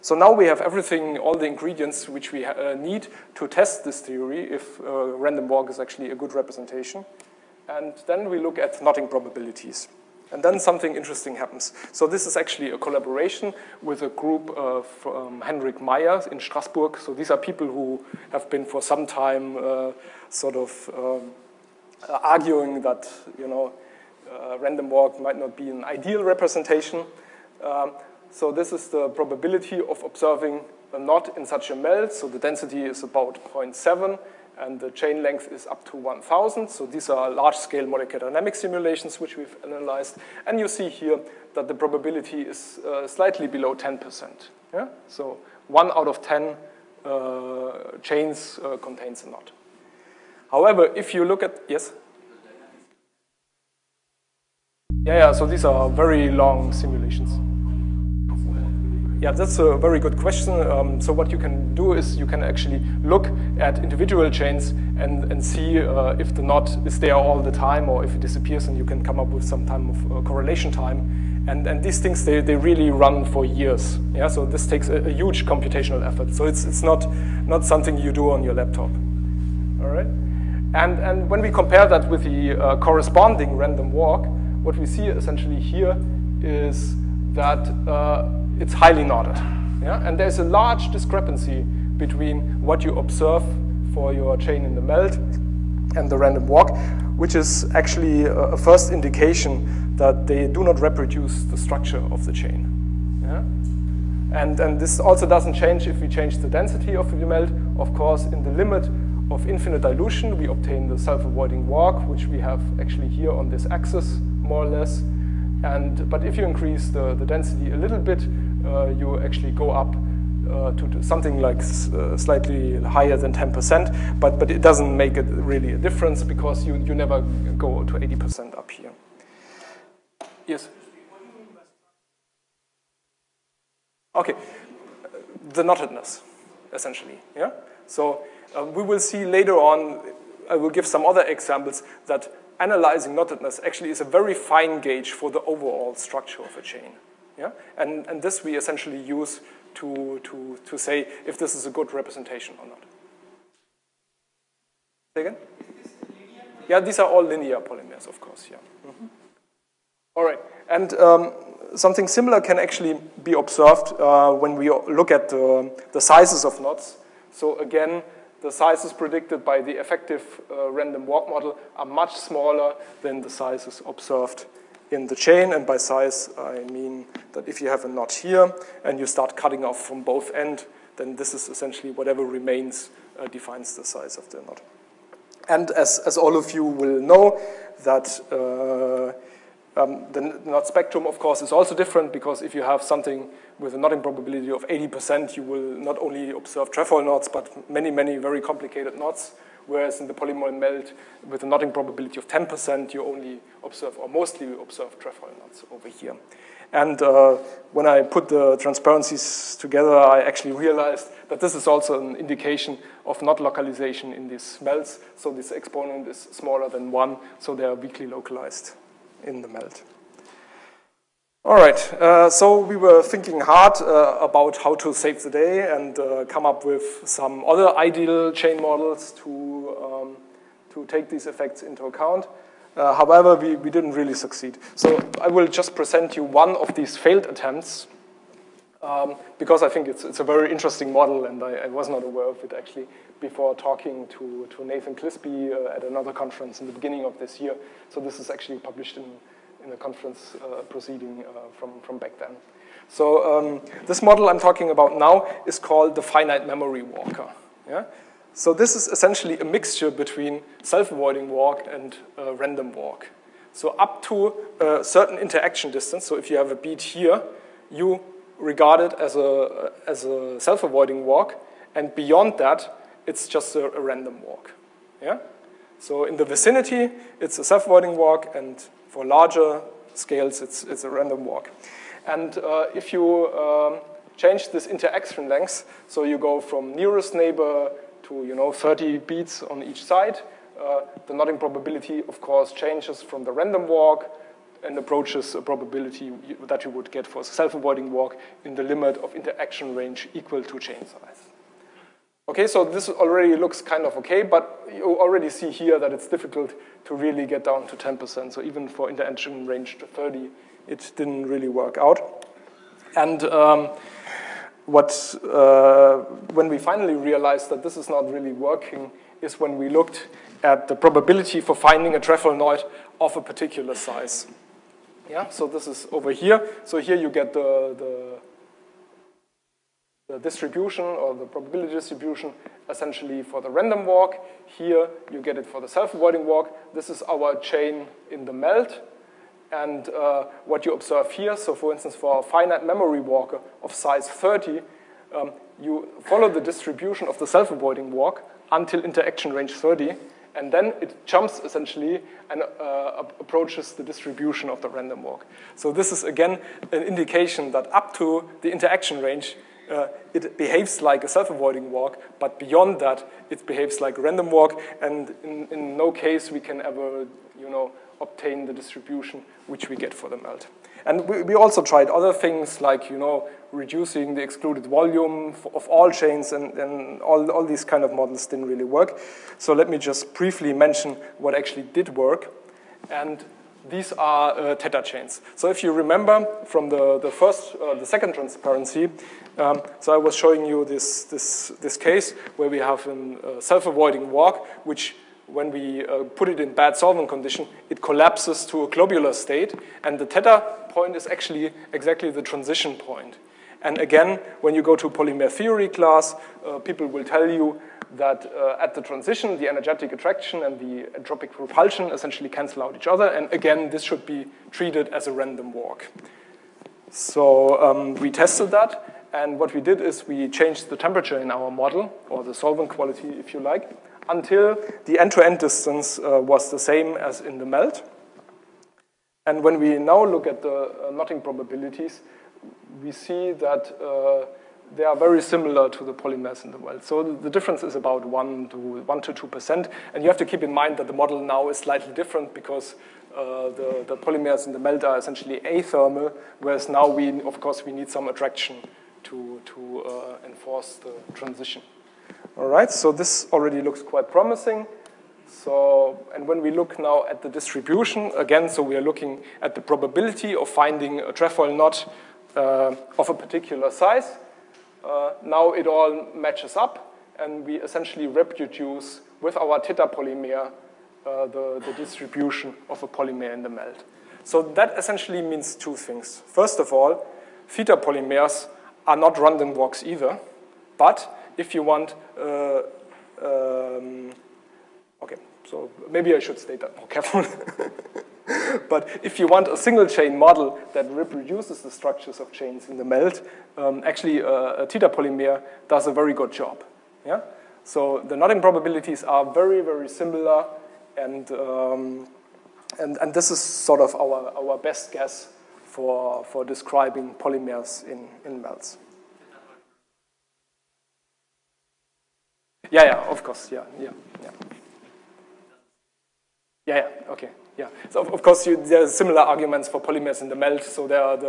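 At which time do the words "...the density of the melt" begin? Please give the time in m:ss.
1:46.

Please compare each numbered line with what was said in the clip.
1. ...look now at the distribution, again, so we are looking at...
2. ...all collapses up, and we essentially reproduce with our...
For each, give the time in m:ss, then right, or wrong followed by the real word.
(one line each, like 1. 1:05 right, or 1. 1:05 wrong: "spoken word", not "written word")
1. 7:36 right
2. 7:45 wrong: "matches", not "collapses".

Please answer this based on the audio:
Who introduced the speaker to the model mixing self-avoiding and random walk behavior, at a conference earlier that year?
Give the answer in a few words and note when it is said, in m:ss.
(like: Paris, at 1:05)
Nathan Clisby, at 4:04.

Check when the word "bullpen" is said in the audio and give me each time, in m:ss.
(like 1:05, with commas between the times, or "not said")
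not said.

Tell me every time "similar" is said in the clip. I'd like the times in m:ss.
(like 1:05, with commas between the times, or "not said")
2:42, 7:15, 8:19, 8:38.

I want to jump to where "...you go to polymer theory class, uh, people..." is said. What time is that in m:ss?
6:44.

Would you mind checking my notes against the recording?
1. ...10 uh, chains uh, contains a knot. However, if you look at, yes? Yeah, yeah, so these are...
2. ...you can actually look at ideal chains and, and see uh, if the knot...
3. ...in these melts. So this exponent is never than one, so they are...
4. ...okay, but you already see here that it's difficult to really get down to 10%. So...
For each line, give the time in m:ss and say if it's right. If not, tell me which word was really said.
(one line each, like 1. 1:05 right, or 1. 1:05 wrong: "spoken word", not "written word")
1. 0:46 right
2. 1:02 wrong: "individual", not "ideal"
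3. 3:34 wrong: "smaller", not "never"
4. 5:03 right.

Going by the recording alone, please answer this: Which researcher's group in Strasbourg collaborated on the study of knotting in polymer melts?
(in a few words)
Hendrik Meyer.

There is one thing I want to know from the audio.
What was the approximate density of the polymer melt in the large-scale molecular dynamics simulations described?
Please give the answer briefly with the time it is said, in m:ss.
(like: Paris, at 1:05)
0.7, at 0:33.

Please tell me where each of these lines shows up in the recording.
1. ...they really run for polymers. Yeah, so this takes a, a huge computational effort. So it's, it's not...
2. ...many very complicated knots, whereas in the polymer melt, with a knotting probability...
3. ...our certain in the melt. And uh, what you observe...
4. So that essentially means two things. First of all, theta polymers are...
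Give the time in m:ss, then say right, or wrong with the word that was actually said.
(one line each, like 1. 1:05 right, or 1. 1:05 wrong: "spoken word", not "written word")
1. 1:12 wrong: "years", not "polymers"
2. 3:17 right
3. 5:37 wrong: "chain", not "certain"
4. 7:54 right.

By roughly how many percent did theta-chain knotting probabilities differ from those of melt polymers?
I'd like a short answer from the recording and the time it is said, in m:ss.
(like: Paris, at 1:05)
1 to 2%, at 7:18.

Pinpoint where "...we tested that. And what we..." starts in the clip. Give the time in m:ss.
6:57.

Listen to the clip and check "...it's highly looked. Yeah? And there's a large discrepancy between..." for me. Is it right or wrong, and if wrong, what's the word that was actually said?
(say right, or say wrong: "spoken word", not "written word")
wrong: "knotted", not "looked".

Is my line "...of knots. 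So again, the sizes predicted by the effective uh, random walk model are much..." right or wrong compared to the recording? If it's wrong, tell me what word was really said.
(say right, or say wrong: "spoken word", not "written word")
right.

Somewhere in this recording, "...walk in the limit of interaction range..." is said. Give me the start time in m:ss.
4:57.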